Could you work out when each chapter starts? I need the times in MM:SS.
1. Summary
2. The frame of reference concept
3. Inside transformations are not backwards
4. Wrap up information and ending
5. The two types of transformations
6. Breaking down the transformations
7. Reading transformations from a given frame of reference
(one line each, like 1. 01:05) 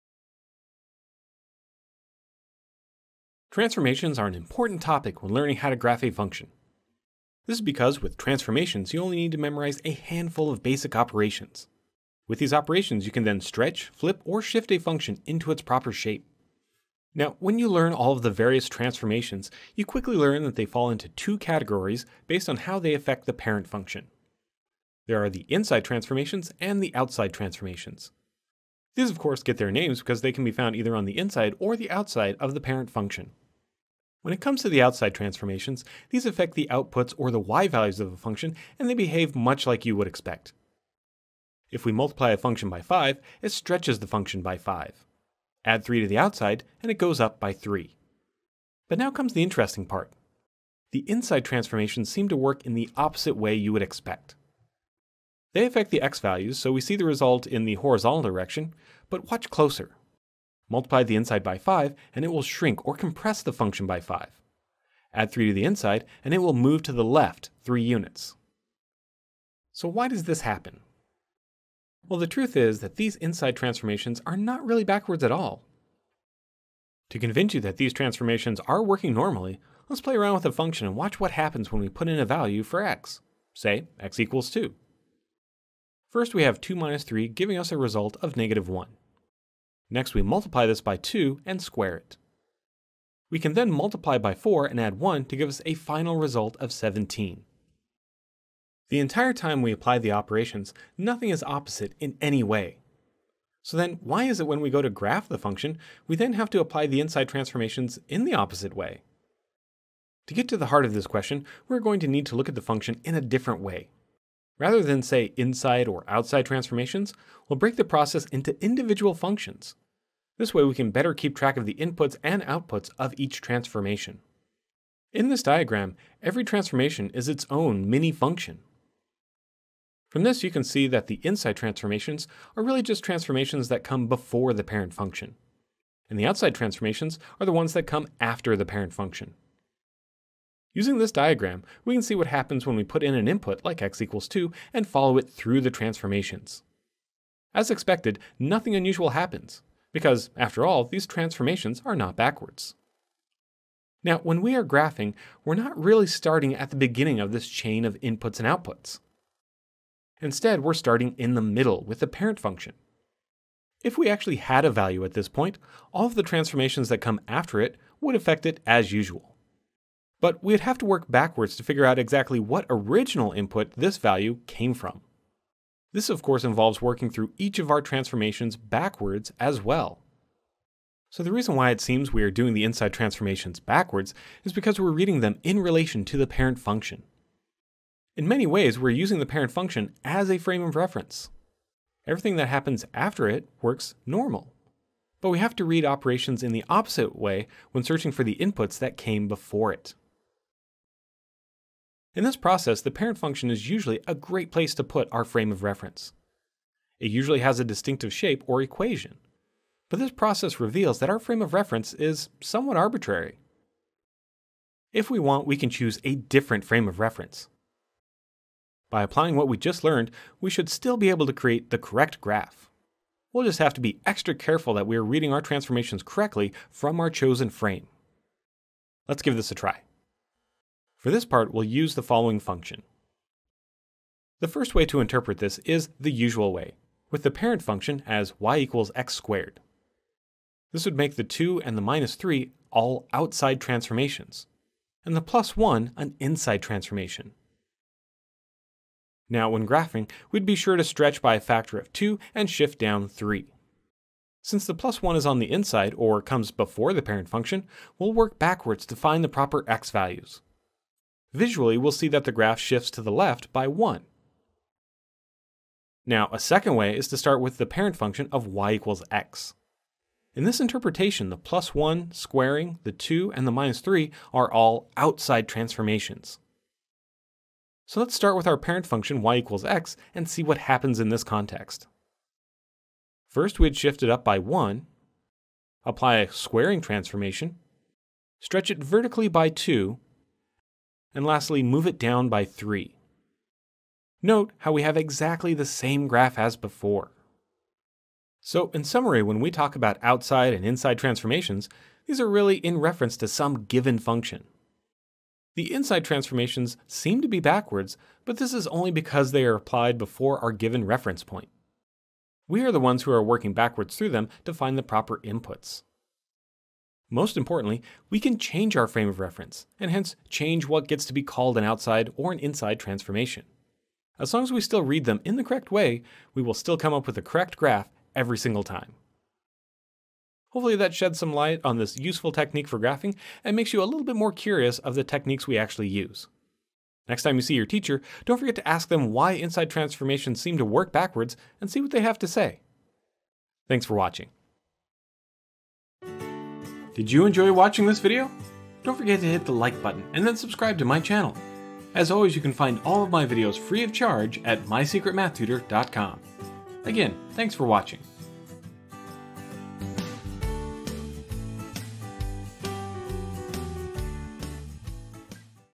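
1. 04:58
2. 02:35
3. 01:11
4. 05:30
5. 00:17
6. 01:50
7. 03:50.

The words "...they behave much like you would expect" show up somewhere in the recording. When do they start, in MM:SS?
00:38.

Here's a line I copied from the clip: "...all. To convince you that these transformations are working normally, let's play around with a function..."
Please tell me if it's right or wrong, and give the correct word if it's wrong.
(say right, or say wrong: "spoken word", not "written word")
right.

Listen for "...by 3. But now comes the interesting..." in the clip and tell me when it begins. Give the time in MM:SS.
00:47.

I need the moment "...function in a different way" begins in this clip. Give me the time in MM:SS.
01:52.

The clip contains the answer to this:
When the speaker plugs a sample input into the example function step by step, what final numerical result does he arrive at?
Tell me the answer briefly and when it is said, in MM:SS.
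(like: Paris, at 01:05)
17, at 01:36.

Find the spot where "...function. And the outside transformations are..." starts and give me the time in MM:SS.
02:14.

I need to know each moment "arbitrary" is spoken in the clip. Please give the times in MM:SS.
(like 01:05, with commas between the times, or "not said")
03:32.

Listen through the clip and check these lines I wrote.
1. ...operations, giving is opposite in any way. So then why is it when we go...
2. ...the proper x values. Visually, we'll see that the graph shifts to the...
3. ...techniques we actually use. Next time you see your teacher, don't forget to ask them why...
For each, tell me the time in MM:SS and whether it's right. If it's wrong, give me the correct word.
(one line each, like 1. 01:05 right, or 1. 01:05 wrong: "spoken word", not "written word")
1. 01:40 wrong: "nothing", not "giving"
2. 04:19 right
3. 05:35 right.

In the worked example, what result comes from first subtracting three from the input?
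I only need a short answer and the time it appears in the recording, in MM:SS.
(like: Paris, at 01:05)
-1, at 01:28.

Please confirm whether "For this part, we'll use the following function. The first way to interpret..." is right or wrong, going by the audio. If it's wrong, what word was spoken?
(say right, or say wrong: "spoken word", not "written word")
right.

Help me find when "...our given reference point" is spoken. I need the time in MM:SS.
05:10.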